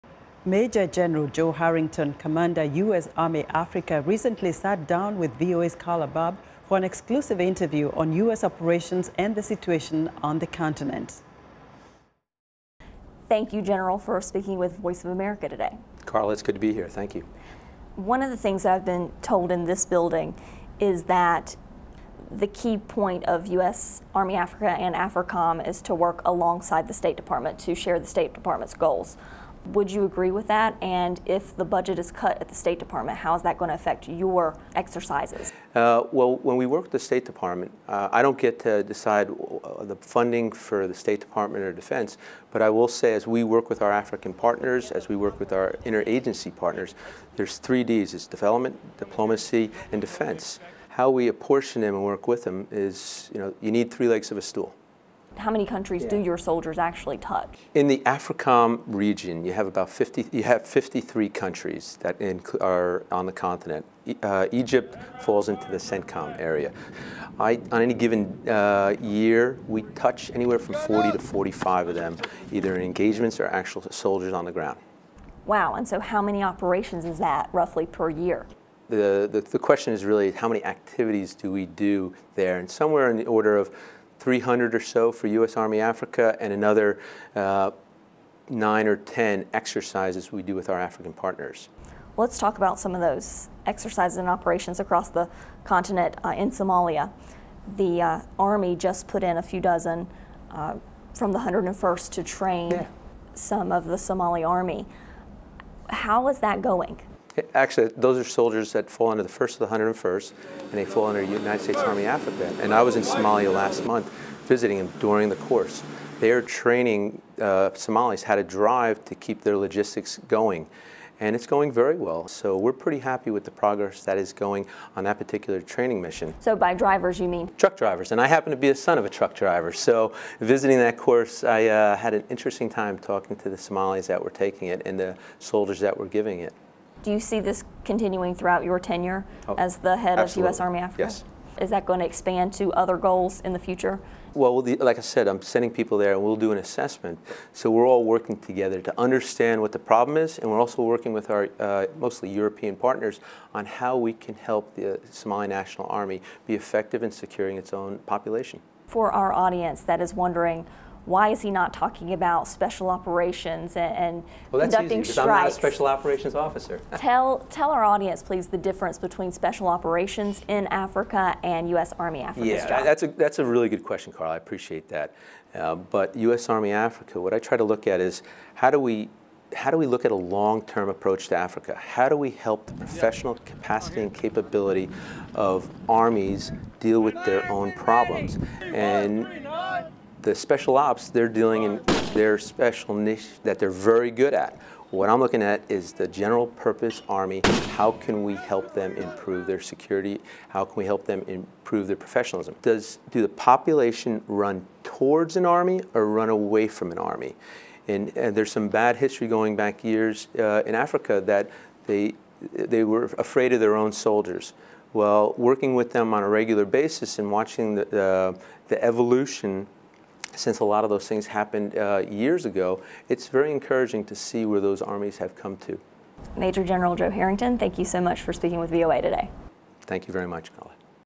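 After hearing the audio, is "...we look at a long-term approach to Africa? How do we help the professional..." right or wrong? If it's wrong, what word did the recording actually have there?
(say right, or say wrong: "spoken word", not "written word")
right.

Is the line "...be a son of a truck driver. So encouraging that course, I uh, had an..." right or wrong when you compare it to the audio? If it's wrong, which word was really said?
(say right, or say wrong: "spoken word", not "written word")
wrong: "visiting", not "encouraging".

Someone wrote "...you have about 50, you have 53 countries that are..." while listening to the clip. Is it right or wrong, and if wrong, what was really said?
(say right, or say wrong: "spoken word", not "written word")
right.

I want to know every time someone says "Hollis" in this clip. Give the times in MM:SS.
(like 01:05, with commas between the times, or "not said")
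not said.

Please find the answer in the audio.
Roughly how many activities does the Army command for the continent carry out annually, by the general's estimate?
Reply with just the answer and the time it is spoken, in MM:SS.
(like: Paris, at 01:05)
300, at 01:24.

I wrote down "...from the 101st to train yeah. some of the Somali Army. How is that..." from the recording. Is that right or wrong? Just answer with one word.
right.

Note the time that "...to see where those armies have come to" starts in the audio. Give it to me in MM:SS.
03:44.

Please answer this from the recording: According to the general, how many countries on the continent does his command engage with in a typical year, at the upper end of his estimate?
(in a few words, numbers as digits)
45.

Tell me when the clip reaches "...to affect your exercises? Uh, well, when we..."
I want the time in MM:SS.
00:33.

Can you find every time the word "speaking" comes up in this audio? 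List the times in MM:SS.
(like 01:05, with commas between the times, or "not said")
00:14, 03:48.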